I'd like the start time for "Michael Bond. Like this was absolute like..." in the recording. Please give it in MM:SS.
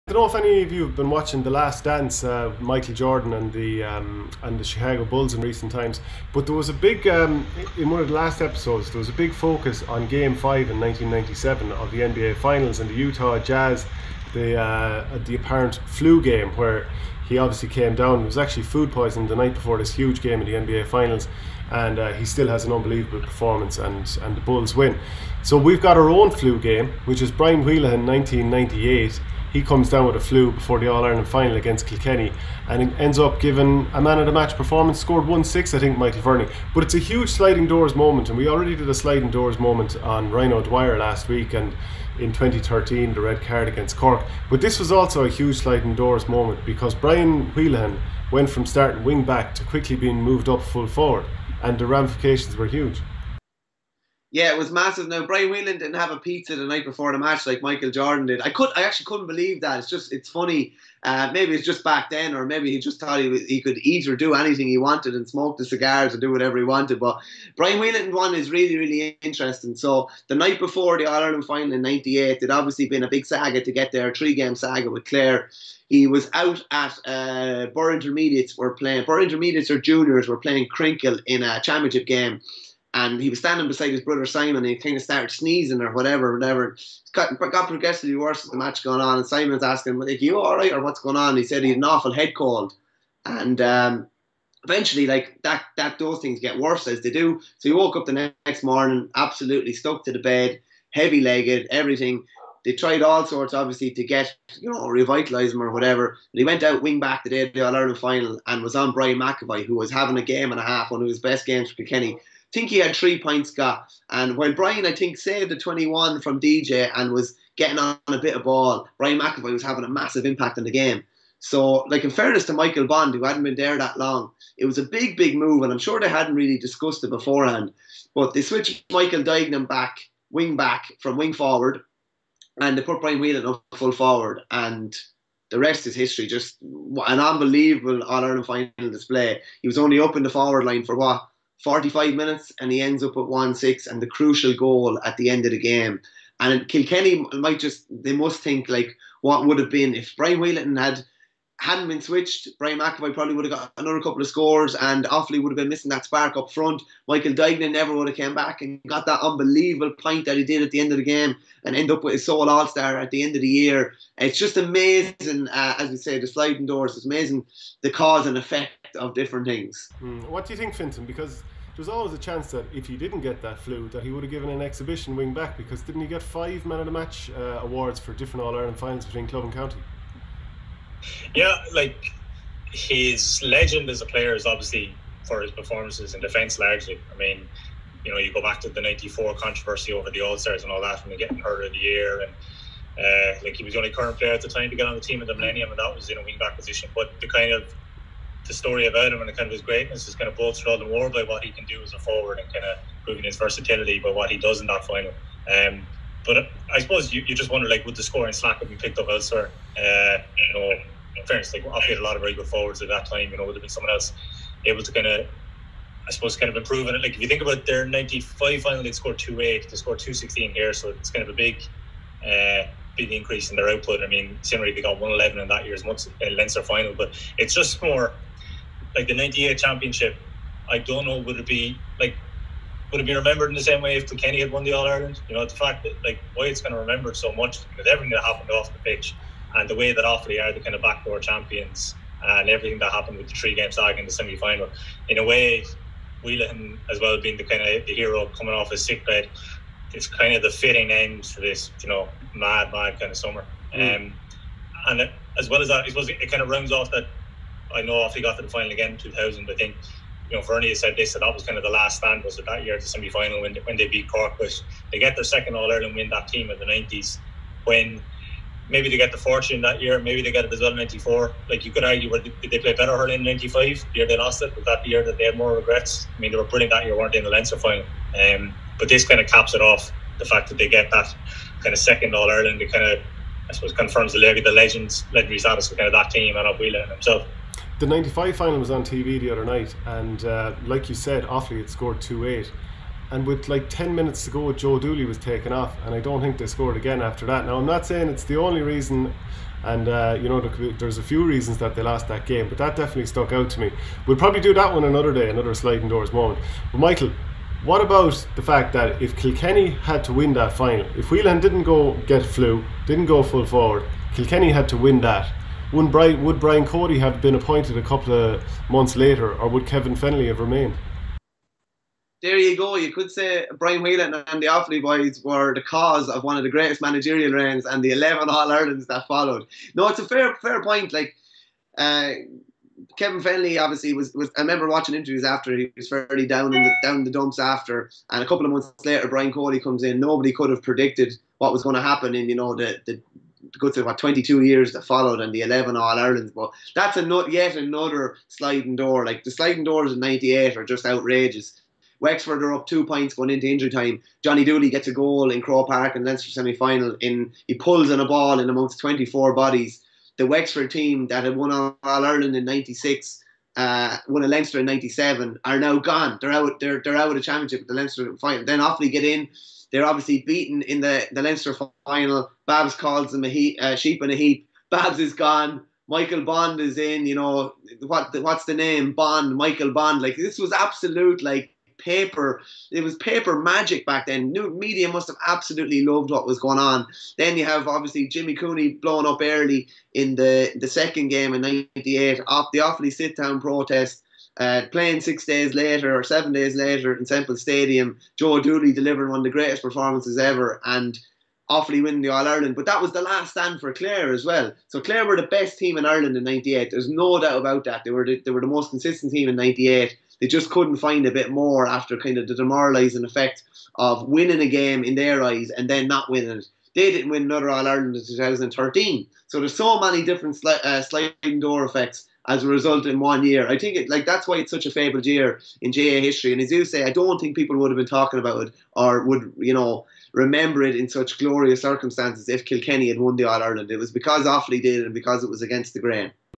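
06:19.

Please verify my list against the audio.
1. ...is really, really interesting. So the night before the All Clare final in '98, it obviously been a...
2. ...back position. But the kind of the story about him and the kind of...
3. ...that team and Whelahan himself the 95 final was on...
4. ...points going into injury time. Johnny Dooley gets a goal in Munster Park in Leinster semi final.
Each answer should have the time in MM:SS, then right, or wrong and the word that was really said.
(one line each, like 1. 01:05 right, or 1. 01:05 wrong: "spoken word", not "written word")
1. 01:08 wrong: "Ireland", not "Clare"
2. 03:16 right
3. 04:45 right
4. 05:52 wrong: "Croke", not "Munster".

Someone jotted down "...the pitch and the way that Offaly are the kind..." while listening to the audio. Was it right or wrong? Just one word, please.
right.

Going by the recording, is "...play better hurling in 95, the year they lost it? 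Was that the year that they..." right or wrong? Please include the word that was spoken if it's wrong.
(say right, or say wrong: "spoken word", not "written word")
right.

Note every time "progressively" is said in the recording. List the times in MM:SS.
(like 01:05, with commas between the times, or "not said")
01:27.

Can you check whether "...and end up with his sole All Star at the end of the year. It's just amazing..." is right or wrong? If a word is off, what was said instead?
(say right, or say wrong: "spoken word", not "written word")
right.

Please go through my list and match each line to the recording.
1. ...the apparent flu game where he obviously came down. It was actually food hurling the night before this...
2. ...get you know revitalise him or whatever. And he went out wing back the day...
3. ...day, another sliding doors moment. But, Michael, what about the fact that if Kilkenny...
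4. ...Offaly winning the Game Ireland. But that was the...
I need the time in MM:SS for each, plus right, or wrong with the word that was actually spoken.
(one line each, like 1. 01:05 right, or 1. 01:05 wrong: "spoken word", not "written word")
1. 00:15 wrong: "poisoning", not "hurling"
2. 01:44 right
3. 05:05 right
4. 06:41 wrong: "All", not "Game".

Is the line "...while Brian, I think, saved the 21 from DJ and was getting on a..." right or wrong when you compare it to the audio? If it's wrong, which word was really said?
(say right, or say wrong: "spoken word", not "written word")
right.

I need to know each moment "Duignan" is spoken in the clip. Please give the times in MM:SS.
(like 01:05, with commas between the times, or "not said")
02:09, 02:37.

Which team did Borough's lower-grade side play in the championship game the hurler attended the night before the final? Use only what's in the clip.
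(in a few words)
Crinkill.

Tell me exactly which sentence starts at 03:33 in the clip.
You know, would have been someone else able to kind of, I suppose, kind of improve on it.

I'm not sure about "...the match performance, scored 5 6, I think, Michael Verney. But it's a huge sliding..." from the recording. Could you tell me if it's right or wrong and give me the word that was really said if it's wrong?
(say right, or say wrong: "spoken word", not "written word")
wrong: "1", not "5".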